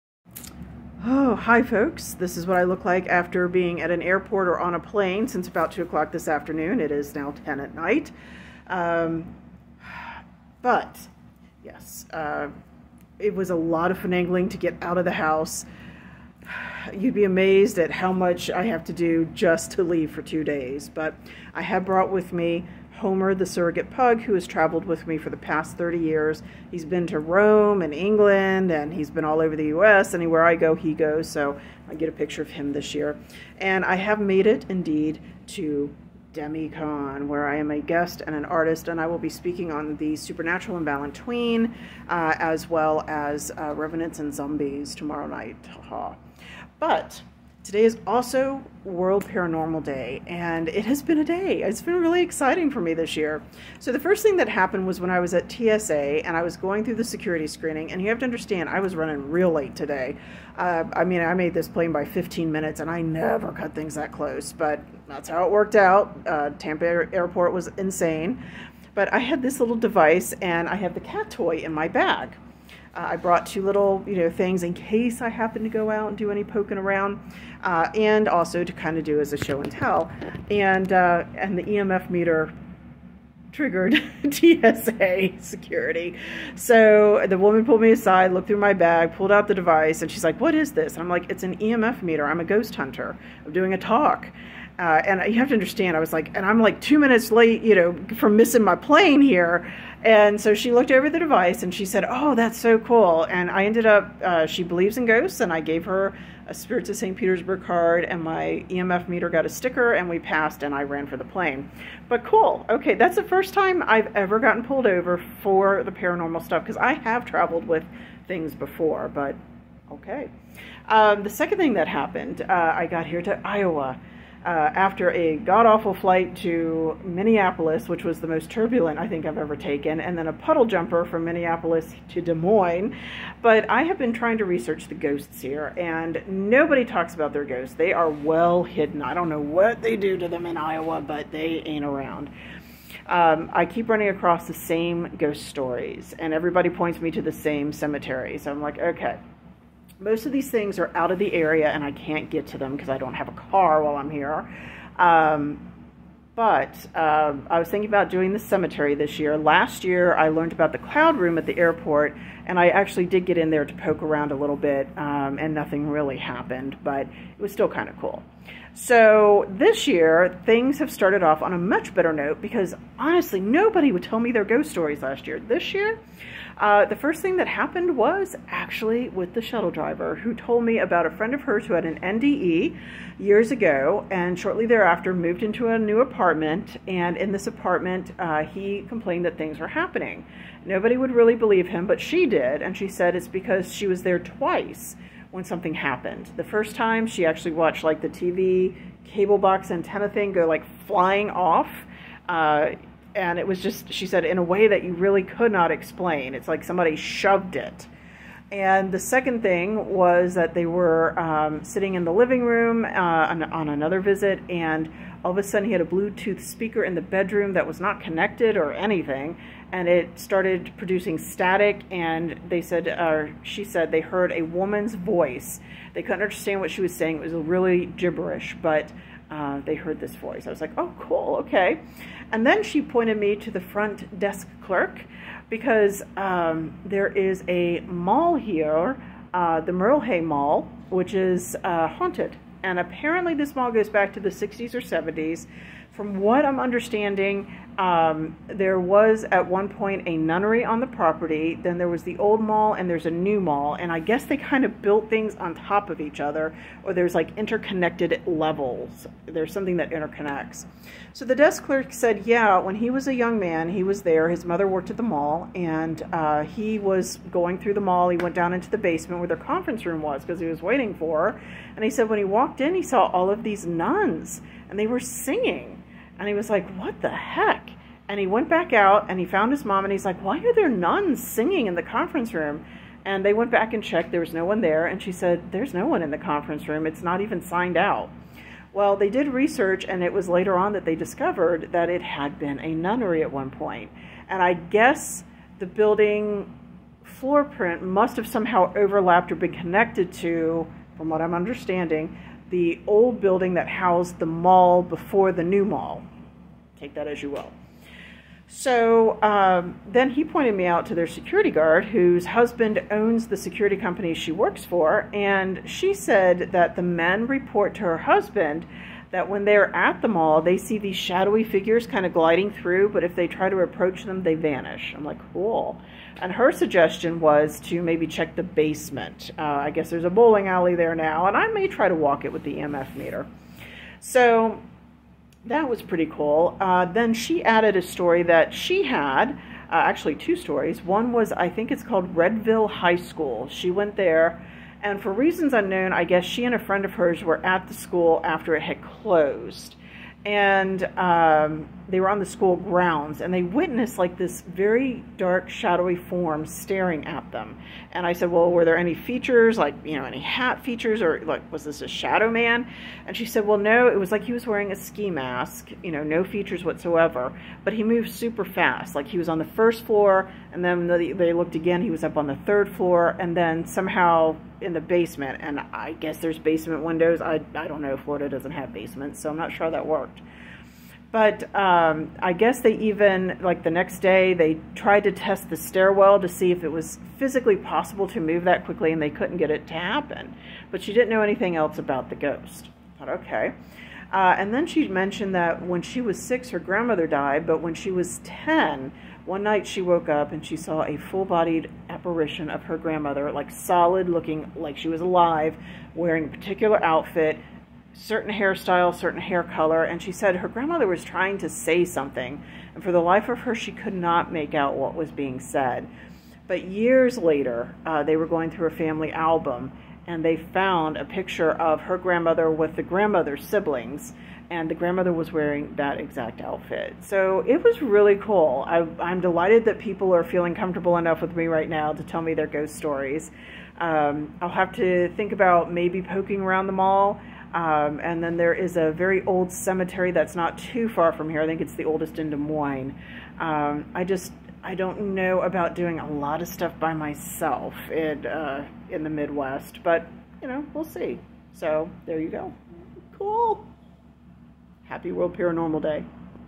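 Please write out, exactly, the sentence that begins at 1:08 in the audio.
But I had this little device, and I had the cat toy in my bag.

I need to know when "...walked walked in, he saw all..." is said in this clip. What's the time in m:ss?
4:32.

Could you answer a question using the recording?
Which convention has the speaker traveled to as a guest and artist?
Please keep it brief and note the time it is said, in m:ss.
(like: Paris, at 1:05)
DemiCon, at 0:36.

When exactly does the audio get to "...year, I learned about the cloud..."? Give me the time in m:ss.
2:39.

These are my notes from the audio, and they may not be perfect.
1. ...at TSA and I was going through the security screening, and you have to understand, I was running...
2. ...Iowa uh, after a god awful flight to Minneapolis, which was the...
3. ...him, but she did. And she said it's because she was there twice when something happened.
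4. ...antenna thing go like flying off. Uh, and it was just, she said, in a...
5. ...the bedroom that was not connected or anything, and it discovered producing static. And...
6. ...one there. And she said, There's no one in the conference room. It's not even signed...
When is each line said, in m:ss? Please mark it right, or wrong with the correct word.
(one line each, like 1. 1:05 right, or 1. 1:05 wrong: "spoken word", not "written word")
1. 0:55 right
2. 2:03 right
3. 3:11 right
4. 3:19 right
5. 3:36 wrong: "started", not "discovered"
6. 4:44 right.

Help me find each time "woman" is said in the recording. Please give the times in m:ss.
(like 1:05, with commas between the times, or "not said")
1:27, 3:44.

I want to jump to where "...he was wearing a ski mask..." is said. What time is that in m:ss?
6:04.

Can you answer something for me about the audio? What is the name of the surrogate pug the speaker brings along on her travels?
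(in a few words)
Homer.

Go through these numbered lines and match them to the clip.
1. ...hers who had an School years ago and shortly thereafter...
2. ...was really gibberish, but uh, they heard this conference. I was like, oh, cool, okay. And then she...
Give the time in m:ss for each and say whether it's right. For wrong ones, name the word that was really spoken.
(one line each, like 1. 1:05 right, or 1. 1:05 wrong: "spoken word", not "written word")
1. 3:01 wrong: "NDE", not "School"
2. 3:47 wrong: "voice", not "conference".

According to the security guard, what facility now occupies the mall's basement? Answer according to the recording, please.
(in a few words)
bowling alley.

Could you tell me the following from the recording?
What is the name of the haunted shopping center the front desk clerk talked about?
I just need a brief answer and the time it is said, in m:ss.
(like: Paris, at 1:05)
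Merle Hay Mall, at 3:59.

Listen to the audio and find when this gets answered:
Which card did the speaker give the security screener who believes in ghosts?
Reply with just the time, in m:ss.
1:46.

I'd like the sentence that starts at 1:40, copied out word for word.
And so she looked over the device and she said, Oh, that's so cool.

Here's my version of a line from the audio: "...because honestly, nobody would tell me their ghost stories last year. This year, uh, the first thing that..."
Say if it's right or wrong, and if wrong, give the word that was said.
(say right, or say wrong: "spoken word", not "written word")
right.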